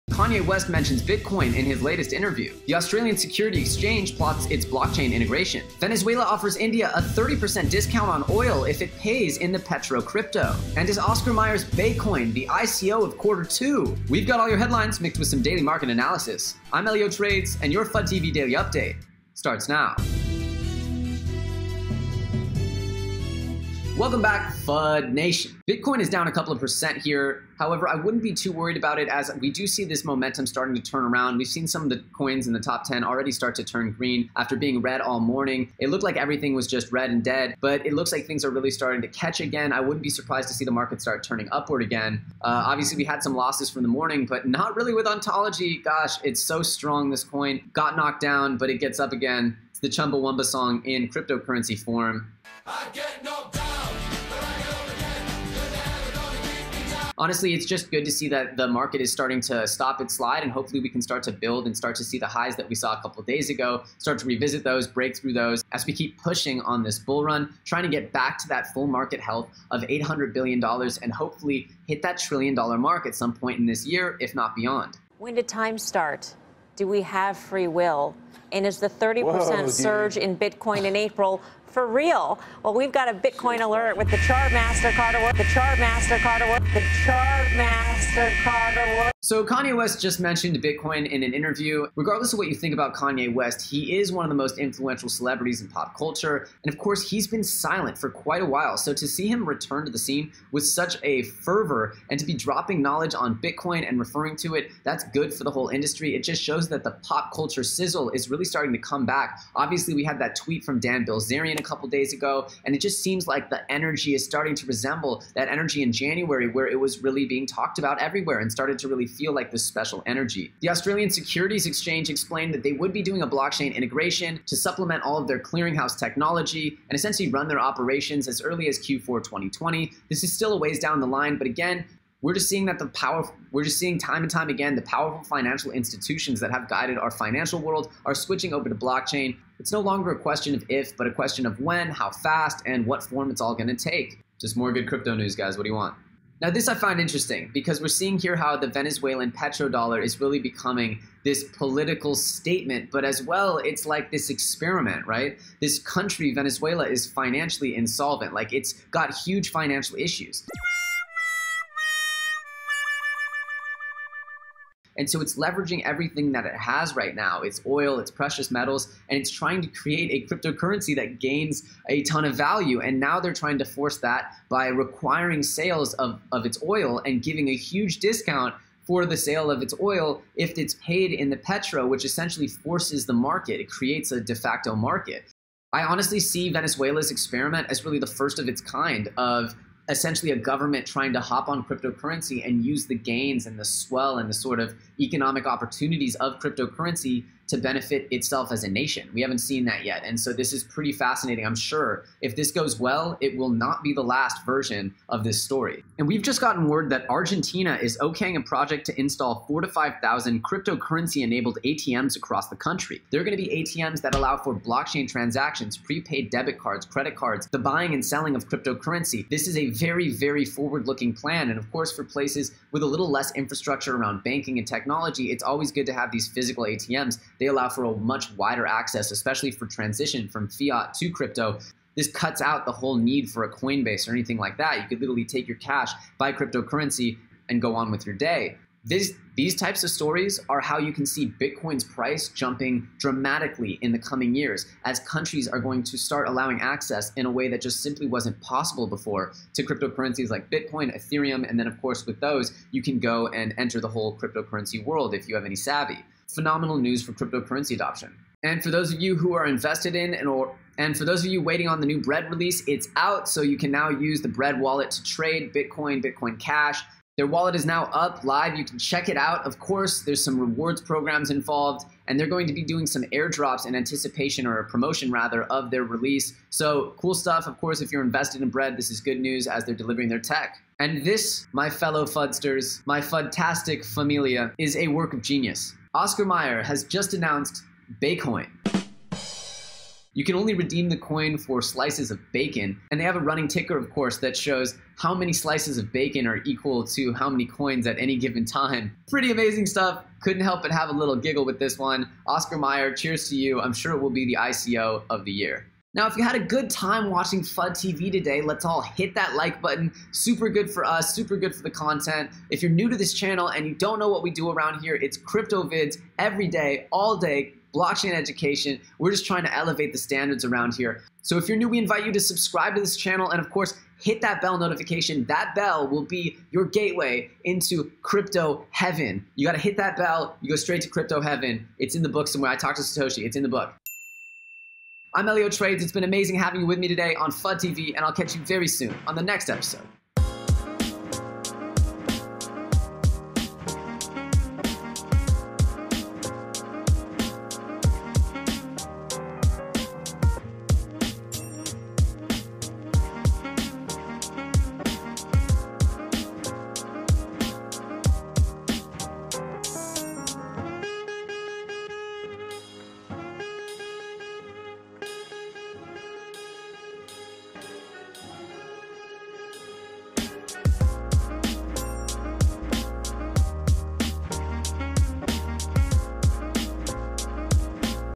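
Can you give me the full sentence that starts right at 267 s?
Their wallet is now up live.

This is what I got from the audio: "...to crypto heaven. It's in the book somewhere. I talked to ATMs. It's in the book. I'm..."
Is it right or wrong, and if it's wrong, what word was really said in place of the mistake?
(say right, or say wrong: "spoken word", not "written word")
wrong: "Satoshi", not "ATMs".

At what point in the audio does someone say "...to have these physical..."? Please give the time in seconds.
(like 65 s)
225 s.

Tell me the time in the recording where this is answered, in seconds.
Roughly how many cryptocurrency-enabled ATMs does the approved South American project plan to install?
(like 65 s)
209 s.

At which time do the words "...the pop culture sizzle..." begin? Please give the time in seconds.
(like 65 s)
106 s.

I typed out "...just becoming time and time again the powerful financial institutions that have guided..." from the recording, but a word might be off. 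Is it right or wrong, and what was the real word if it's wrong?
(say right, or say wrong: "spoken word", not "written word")
wrong: "seeing", not "becoming".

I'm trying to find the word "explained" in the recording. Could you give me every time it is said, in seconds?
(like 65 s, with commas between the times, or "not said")
122 s.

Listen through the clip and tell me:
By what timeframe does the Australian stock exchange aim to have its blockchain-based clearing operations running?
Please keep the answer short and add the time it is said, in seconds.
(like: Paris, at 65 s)
Q4 2020, at 128 s.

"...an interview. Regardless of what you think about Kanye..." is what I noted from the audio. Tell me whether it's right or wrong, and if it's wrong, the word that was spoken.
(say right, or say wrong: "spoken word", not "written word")
right.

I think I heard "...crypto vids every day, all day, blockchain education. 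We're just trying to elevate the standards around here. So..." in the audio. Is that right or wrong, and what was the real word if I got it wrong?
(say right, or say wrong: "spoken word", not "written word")
right.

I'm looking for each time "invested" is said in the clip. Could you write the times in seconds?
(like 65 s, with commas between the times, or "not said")
259 s, 278 s.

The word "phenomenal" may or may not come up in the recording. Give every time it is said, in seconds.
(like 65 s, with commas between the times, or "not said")
256 s.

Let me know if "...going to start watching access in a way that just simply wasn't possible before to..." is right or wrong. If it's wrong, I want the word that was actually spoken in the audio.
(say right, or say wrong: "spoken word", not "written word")
wrong: "allowing", not "watching".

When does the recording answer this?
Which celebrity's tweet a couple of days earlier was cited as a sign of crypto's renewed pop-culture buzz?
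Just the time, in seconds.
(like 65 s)
110 s.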